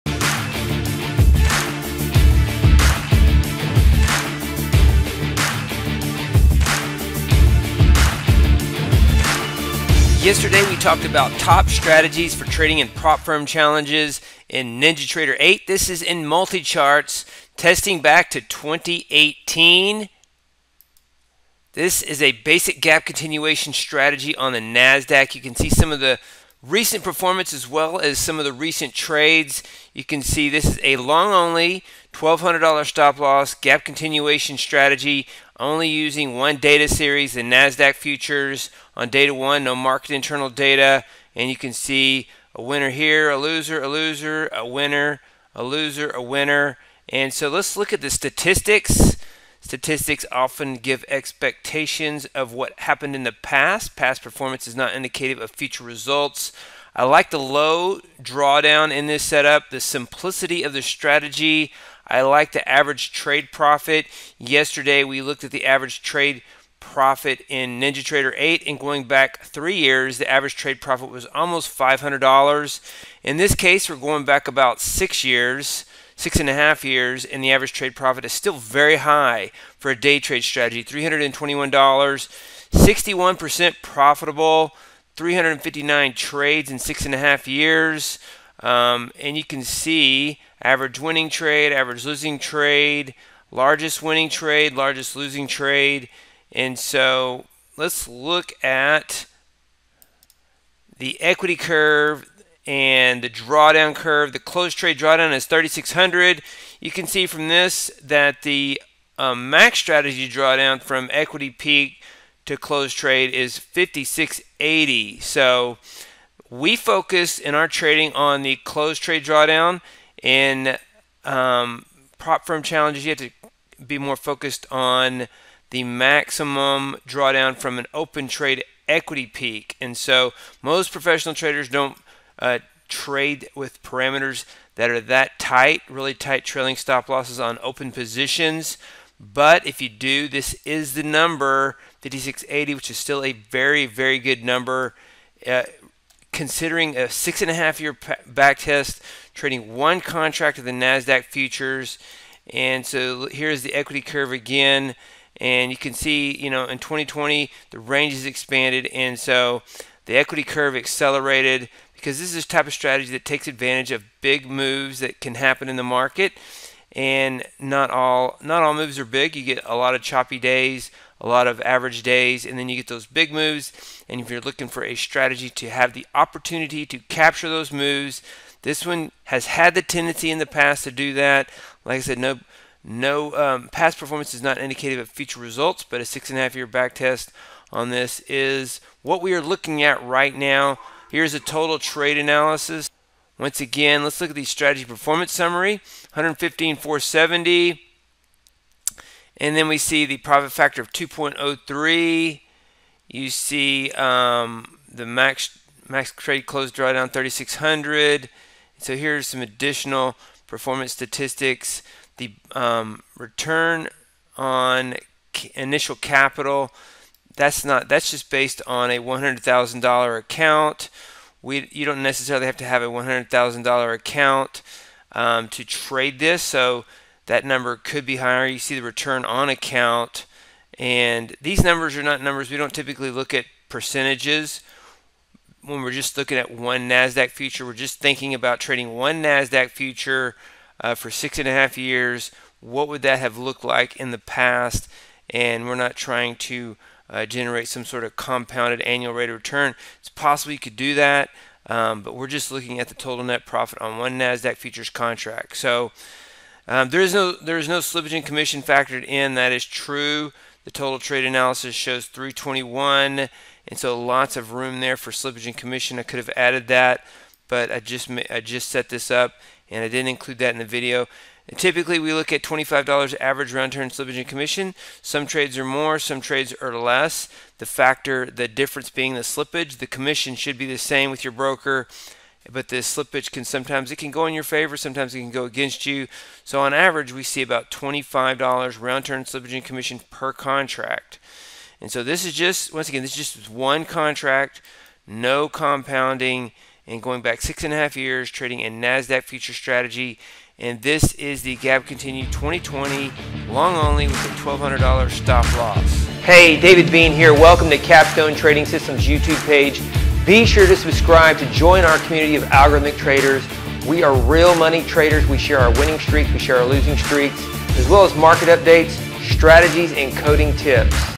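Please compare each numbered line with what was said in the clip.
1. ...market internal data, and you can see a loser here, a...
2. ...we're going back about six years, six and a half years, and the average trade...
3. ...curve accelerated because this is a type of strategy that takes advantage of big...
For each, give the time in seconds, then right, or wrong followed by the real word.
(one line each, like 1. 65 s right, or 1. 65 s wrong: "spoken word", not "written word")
1. 39 s wrong: "winner", not "loser"
2. 73 s right
3. 160 s right.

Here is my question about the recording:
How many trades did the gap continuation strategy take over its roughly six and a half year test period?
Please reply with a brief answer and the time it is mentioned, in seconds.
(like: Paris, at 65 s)
359, at 85 s.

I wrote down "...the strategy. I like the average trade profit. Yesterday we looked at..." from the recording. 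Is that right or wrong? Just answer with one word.
right.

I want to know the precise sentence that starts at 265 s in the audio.
I could have added that, but I just I just set this up and I didn't include that in the video.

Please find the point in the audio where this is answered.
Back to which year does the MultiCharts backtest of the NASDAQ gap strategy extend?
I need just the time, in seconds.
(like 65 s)
18 s.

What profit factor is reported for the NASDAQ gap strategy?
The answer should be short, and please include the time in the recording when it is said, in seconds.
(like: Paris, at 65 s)
2.03, at 200 s.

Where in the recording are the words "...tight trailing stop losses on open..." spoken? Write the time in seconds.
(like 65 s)
136 s.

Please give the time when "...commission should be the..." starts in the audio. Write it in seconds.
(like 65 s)
279 s.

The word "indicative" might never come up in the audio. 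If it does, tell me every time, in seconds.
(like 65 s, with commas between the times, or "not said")
54 s, 184 s.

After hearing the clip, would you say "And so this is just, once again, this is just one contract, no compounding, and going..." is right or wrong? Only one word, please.
right.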